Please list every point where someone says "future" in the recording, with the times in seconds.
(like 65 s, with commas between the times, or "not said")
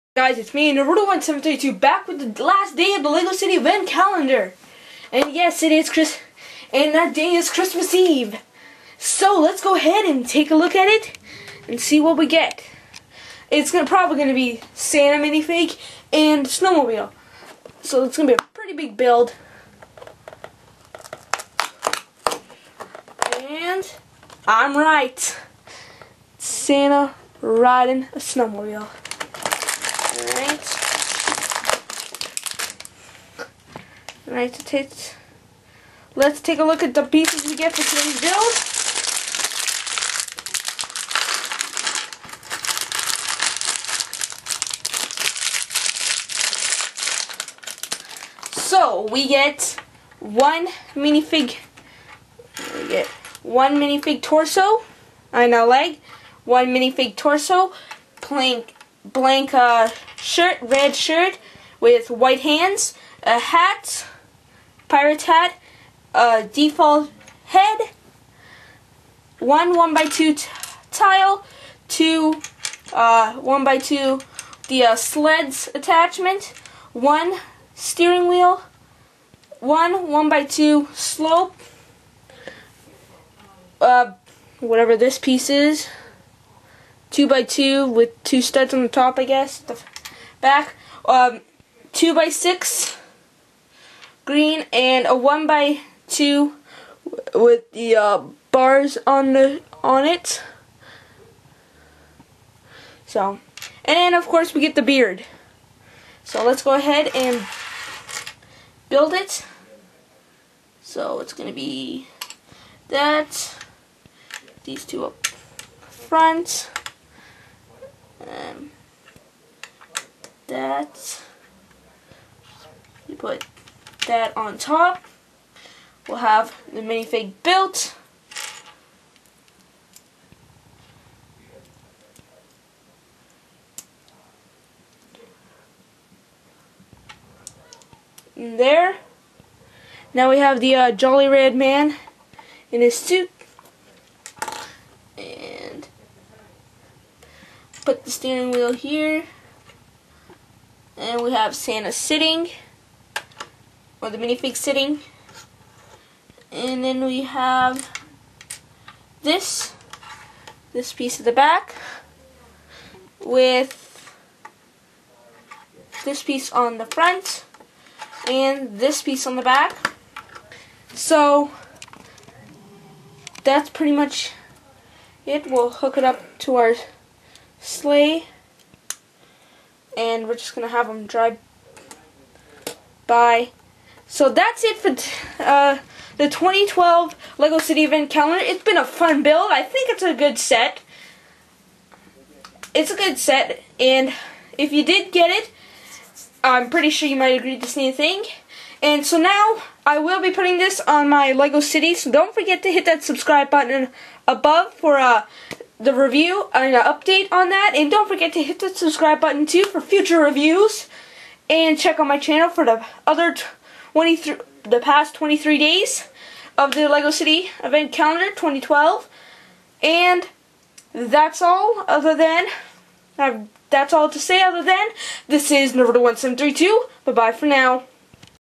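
209 s.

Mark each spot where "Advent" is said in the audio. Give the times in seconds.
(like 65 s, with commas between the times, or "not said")
3 s, 187 s, 217 s.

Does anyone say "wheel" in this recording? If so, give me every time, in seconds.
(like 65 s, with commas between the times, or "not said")
78 s, 148 s.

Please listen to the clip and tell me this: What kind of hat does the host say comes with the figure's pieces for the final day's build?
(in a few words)
Pirate hat.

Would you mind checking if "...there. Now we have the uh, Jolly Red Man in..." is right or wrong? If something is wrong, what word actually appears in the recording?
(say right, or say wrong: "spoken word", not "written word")
right.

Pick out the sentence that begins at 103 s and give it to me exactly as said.
So, and then of course we get the beard.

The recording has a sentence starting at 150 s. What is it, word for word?
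And we have Santa sitting, or the minifig sitting.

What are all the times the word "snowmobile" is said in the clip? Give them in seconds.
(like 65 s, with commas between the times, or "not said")
16 s, 28 s.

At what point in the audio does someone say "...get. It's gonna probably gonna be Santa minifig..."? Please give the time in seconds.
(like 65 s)
12 s.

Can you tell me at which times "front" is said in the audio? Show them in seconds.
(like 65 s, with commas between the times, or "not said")
115 s, 166 s.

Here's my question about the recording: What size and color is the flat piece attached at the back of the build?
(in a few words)
2x6 green.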